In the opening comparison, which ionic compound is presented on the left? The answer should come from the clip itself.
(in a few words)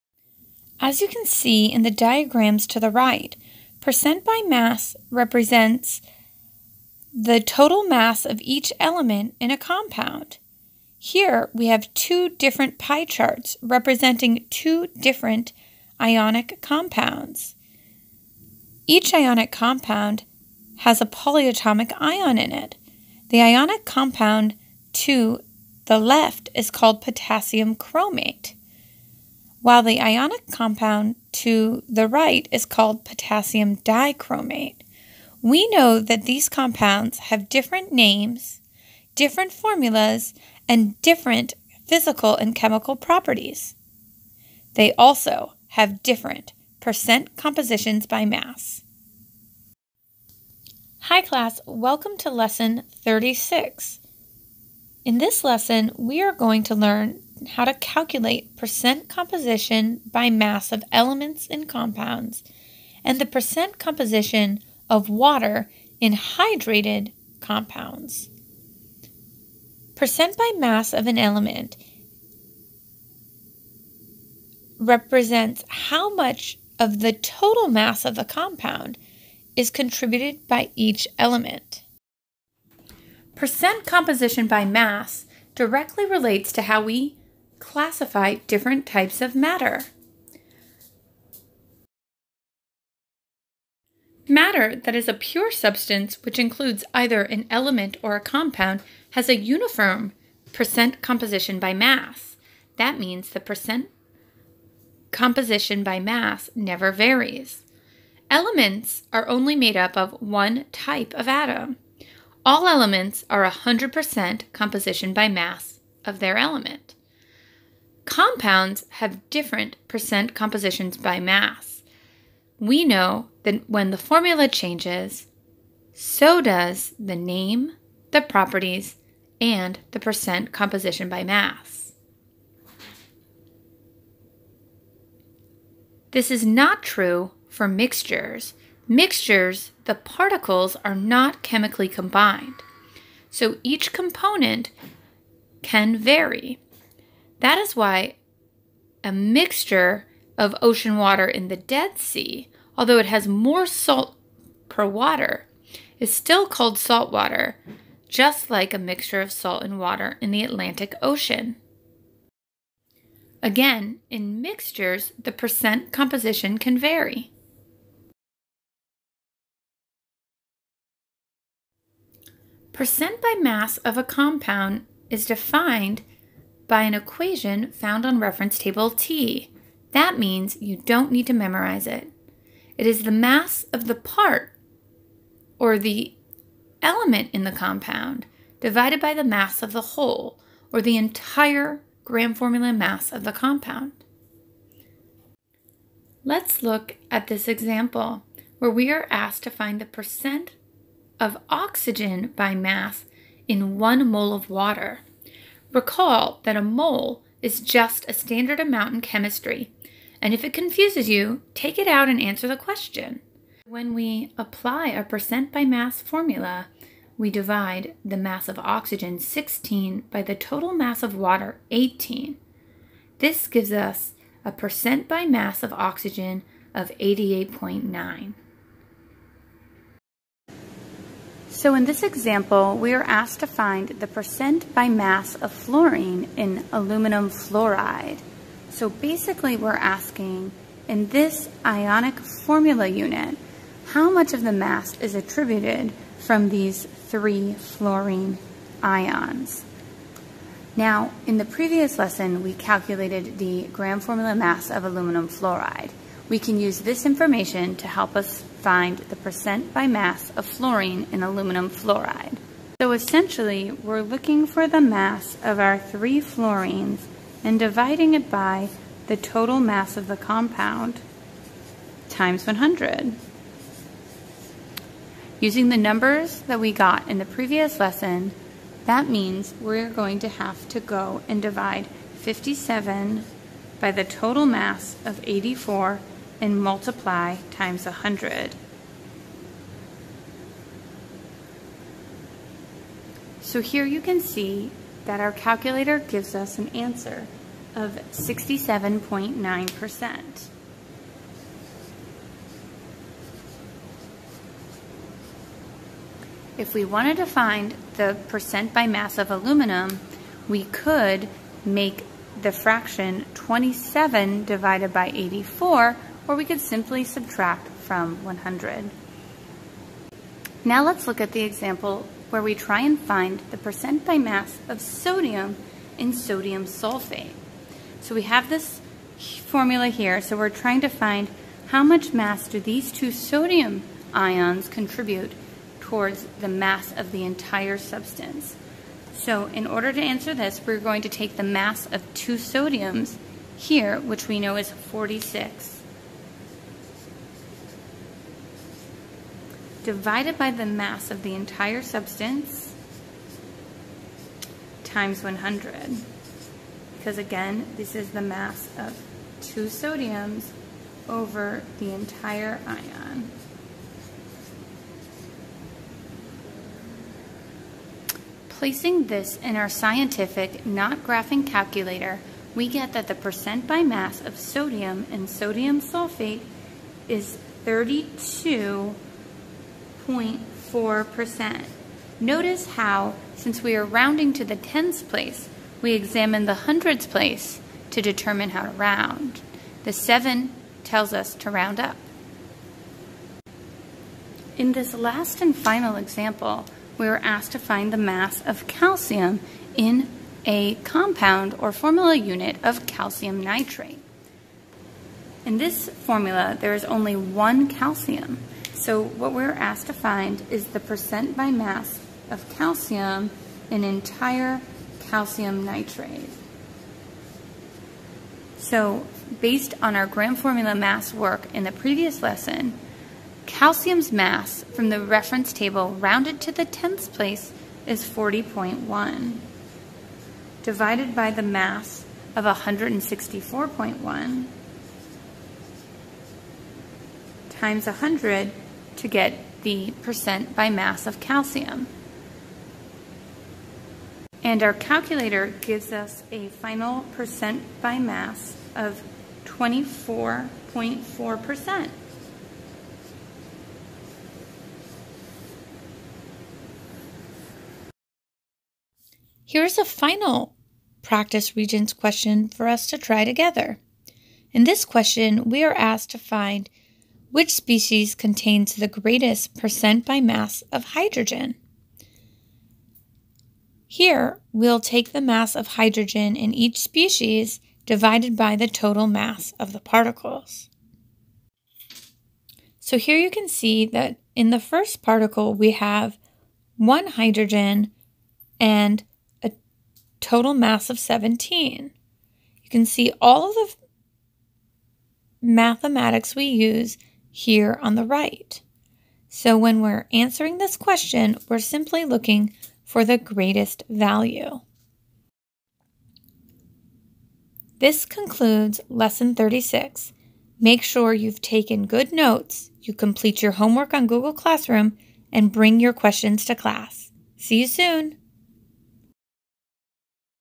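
potassium chromate.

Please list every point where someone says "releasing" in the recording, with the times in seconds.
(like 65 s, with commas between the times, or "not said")
not said.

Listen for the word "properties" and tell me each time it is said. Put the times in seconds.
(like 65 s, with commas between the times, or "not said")
42 s, 128 s.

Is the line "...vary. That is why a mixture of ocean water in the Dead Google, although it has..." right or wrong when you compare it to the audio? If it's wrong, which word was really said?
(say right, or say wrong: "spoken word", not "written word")
wrong: "Sea", not "Google".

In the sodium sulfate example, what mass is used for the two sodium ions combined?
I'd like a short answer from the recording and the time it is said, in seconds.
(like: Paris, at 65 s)
46, at 344 s.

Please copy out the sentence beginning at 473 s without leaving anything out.
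Here, we'll take the mass of hydrogen in each species divided by the total mass of the particles.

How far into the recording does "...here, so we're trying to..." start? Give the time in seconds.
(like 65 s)
329 s.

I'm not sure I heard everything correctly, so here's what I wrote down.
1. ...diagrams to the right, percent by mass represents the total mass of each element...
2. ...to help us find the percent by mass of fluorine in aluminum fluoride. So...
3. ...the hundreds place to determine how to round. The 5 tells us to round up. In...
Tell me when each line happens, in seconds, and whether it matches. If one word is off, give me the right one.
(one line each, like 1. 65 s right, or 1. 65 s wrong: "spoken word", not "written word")
1. 1 s right
2. 257 s right
3. 386 s wrong: "7", not "5".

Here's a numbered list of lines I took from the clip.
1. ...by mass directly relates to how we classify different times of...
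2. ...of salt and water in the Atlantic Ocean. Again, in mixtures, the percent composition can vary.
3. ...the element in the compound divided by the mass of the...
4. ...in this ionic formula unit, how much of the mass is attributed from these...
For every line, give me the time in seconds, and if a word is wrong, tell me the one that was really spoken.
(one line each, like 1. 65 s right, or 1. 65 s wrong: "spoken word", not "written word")
1. 84 s wrong: "types", not "times"
2. 159 s right
3. 185 s right
4. 240 s right.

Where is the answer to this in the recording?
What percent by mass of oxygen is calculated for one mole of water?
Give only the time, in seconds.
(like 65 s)
226 s.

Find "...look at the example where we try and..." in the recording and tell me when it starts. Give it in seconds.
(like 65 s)
321 s.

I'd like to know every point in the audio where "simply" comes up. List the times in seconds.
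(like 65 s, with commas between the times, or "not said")
316 s, 501 s.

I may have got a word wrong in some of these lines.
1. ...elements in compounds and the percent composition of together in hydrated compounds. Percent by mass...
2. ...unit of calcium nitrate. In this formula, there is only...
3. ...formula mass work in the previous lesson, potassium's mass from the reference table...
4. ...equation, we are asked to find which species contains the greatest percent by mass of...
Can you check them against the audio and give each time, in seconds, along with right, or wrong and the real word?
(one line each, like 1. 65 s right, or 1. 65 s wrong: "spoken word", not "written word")
1. 60 s wrong: "water", not "together"
2. 402 s right
3. 420 s wrong: "calcium", not "potassium"
4. 464 s wrong: "question", not "equation".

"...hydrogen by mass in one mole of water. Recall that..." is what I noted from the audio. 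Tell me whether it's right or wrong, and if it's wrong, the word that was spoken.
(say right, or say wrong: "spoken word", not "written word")
wrong: "oxygen", not "hydrogen".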